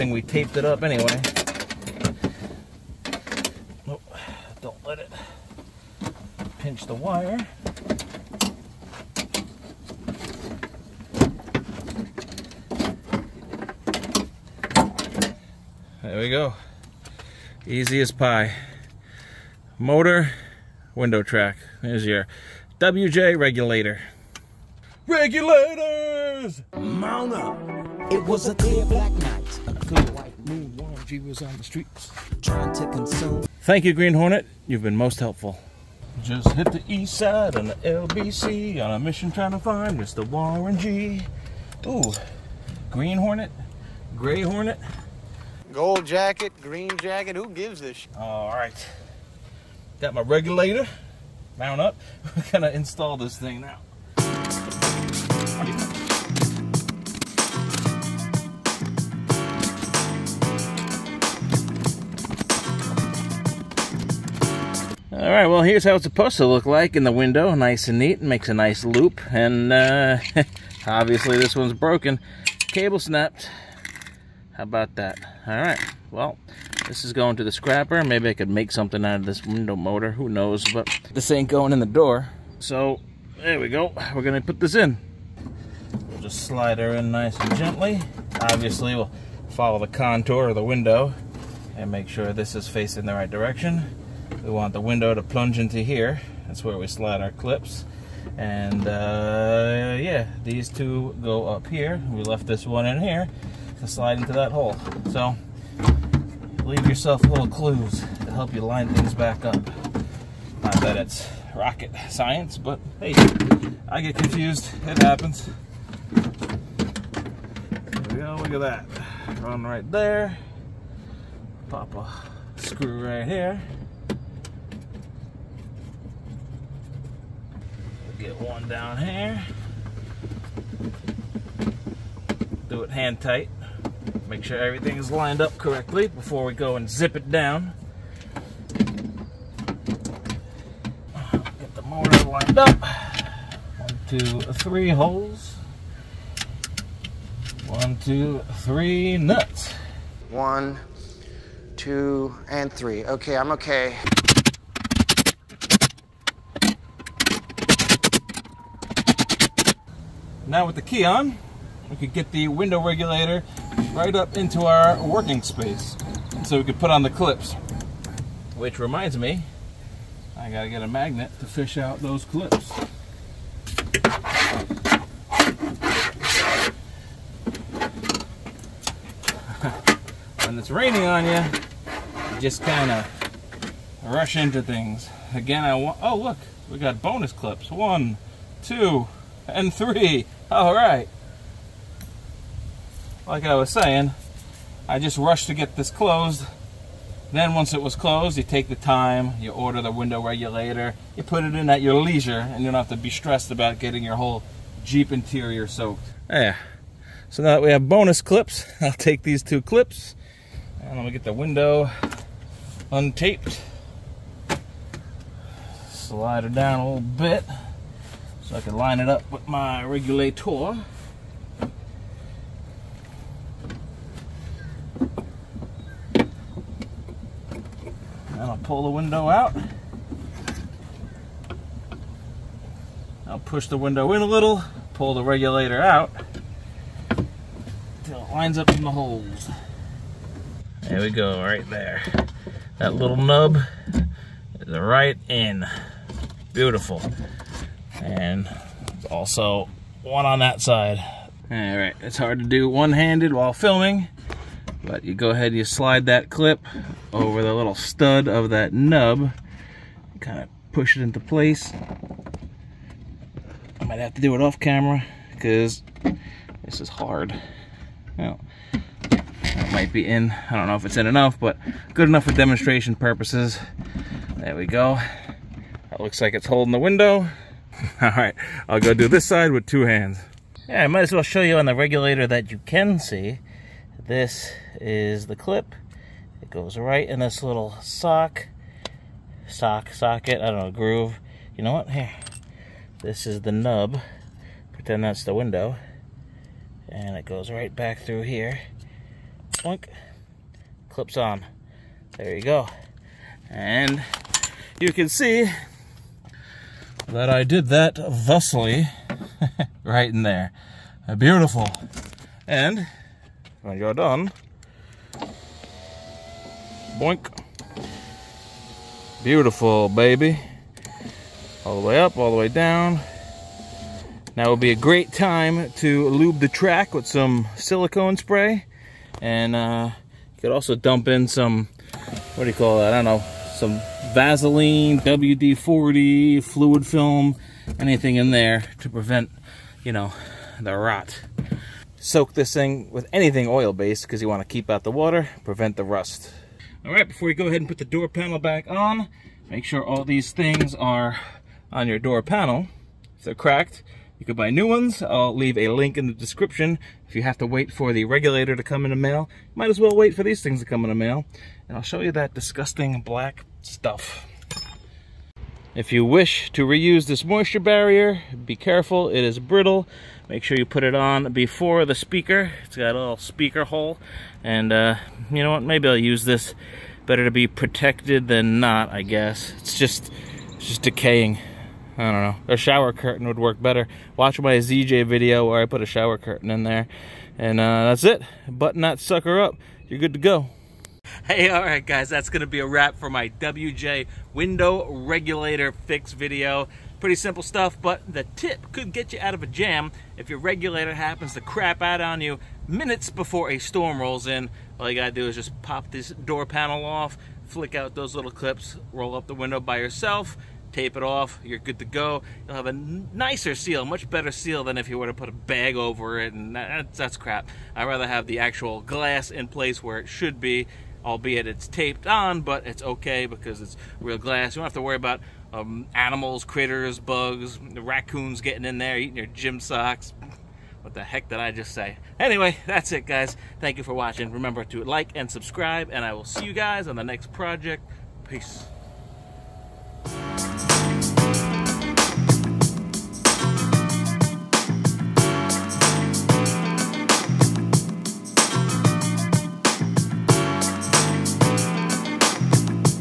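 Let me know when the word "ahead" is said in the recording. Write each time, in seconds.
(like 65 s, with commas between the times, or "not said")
255 s, 347 s.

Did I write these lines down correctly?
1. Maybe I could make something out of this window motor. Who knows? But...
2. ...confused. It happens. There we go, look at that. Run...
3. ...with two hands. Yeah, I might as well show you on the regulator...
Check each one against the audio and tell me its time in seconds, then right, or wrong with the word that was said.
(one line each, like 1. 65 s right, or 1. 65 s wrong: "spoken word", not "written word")
1. 78 s right
2. 114 s right
3. 279 s right.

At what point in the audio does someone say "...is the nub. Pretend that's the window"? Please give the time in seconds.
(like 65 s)
293 s.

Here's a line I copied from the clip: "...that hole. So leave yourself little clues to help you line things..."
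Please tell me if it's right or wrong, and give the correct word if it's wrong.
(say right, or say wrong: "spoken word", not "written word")
right.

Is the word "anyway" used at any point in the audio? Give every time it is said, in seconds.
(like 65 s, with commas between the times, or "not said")
0 s, 432 s.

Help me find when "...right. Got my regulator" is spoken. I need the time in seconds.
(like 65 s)
48 s.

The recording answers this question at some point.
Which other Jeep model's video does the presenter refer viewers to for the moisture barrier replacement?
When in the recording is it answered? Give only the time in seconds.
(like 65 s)
384 s.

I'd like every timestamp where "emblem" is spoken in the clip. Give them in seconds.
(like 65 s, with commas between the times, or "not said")
not said.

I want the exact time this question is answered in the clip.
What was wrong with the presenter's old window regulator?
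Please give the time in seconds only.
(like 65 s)
72 s.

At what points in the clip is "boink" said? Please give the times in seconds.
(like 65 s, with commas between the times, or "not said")
299 s, 316 s.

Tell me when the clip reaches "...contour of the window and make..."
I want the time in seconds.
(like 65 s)
89 s.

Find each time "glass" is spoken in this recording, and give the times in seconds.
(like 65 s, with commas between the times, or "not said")
418 s, 424 s.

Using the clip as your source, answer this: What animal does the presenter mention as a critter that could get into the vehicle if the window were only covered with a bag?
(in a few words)
Raccoons.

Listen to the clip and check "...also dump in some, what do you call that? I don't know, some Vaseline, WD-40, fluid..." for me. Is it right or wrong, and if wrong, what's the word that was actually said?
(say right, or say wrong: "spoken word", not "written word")
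right.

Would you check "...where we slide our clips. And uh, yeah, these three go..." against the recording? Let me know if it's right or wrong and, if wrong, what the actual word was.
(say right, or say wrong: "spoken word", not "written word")
wrong: "two", not "three".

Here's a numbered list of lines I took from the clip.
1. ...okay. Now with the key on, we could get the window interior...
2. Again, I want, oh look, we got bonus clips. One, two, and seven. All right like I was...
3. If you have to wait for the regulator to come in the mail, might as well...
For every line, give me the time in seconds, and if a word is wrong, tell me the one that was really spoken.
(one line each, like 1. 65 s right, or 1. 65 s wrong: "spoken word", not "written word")
1. 153 s wrong: "regulator", not "interior"
2. 185 s wrong: "three", not "seven"
3. 357 s right.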